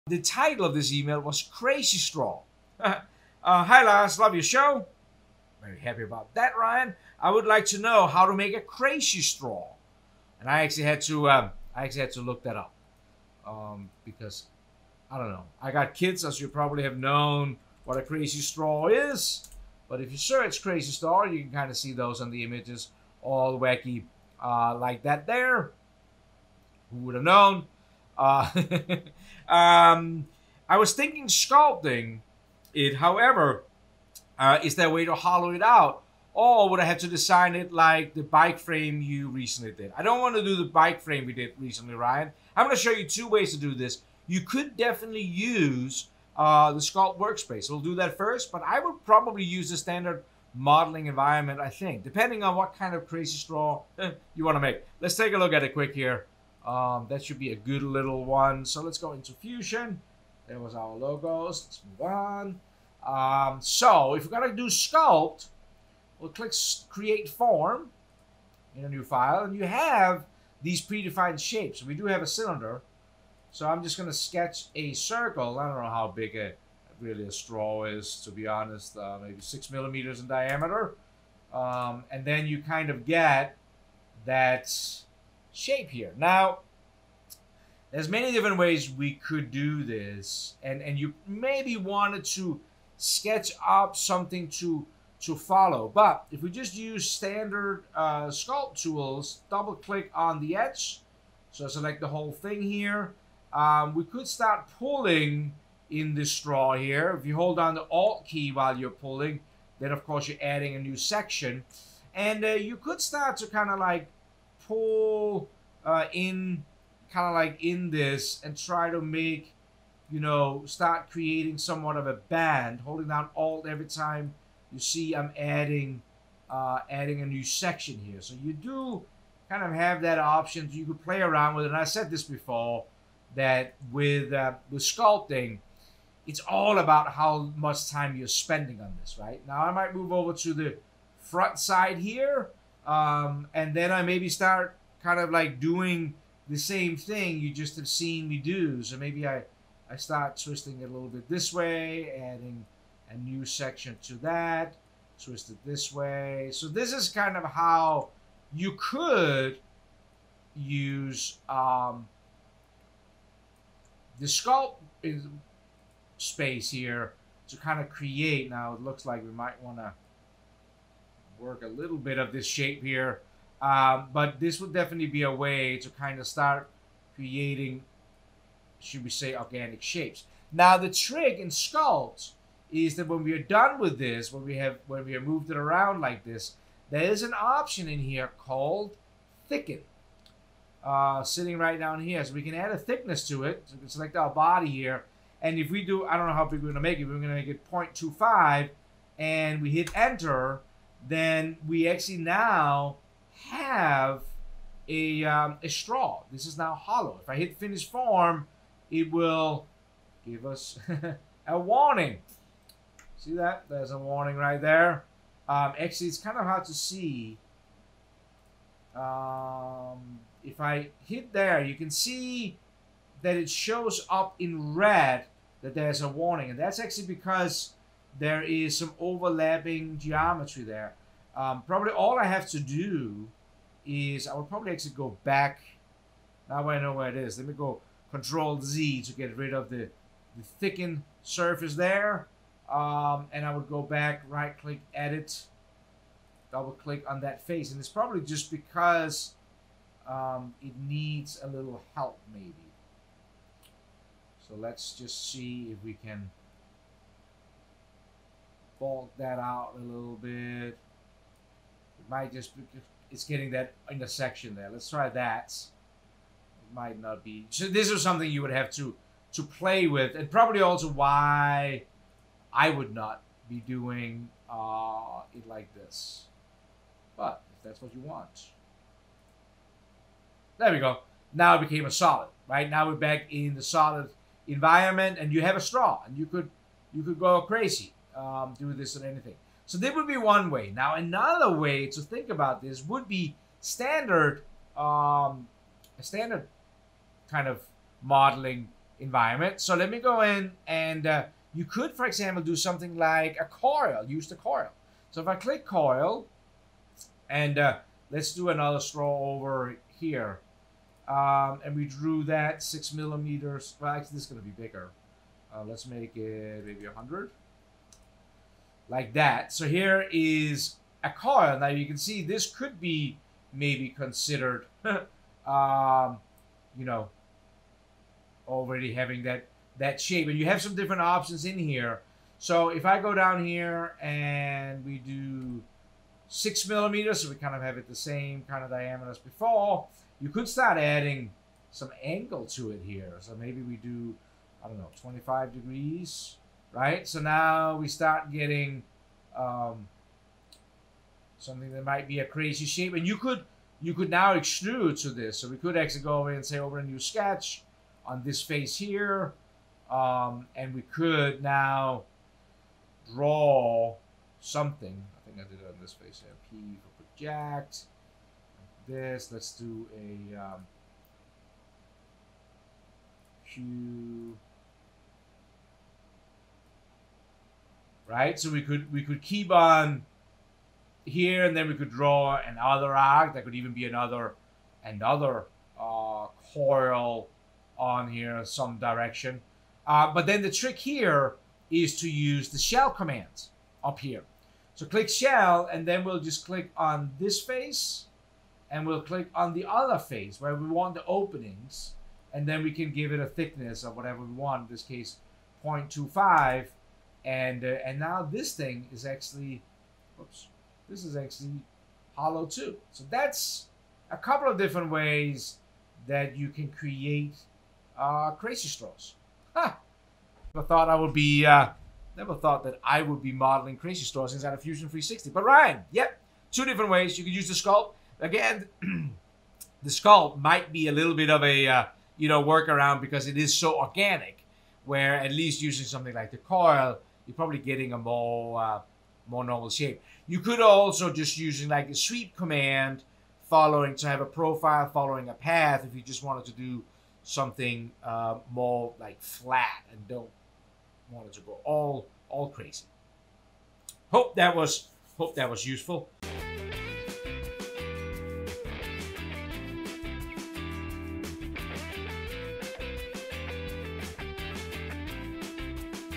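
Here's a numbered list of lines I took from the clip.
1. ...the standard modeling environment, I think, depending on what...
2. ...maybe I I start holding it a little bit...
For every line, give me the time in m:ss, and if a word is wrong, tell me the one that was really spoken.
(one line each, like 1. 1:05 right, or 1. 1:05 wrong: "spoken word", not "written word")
1. 0:49 right
2. 2:28 wrong: "twisting", not "holding".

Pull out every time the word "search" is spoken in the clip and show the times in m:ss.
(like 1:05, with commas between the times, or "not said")
0:20.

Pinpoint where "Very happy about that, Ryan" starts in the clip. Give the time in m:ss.
0:05.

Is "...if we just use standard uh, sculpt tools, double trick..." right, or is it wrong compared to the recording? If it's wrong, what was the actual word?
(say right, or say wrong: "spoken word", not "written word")
wrong: "click", not "trick".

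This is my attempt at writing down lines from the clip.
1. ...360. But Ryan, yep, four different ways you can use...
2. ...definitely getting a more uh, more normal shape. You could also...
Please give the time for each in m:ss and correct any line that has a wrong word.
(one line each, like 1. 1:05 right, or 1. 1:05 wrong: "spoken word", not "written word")
1. 7:04 wrong: "two", not "four"
2. 7:17 wrong: "probably", not "definitely".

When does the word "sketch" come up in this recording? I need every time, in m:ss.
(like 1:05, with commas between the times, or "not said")
1:14, 1:32, 5:56.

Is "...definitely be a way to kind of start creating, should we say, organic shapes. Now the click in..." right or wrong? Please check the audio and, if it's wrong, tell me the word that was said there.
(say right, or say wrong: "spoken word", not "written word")
wrong: "trick", not "click".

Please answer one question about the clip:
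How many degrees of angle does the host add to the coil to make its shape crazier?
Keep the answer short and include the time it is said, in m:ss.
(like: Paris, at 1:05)
25 degrees, at 5:45.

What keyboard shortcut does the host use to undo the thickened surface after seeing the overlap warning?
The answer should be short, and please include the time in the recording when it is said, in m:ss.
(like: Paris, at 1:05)
Control Z, at 3:58.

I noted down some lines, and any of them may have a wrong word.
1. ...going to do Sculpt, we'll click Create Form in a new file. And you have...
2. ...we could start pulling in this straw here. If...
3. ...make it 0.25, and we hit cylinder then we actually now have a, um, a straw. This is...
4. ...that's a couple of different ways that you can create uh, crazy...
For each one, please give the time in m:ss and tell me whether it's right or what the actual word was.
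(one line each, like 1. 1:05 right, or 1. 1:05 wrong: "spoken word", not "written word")
1. 1:04 right
2. 1:43 right
3. 3:17 wrong: "enter", not "cylinder"
4. 6:53 right.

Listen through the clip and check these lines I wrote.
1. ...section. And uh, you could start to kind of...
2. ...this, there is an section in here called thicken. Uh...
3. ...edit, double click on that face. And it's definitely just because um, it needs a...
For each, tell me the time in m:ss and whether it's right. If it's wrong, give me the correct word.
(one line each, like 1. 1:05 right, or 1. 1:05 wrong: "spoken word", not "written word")
1. 1:50 right
2. 3:06 wrong: "option", not "section"
3. 4:04 wrong: "probably", not "definitely".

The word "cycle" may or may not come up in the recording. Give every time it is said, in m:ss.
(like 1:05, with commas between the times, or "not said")
not said.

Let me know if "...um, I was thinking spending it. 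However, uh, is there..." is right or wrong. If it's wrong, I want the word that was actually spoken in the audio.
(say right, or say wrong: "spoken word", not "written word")
wrong: "sculpting", not "spending".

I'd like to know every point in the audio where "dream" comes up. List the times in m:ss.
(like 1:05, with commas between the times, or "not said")
not said.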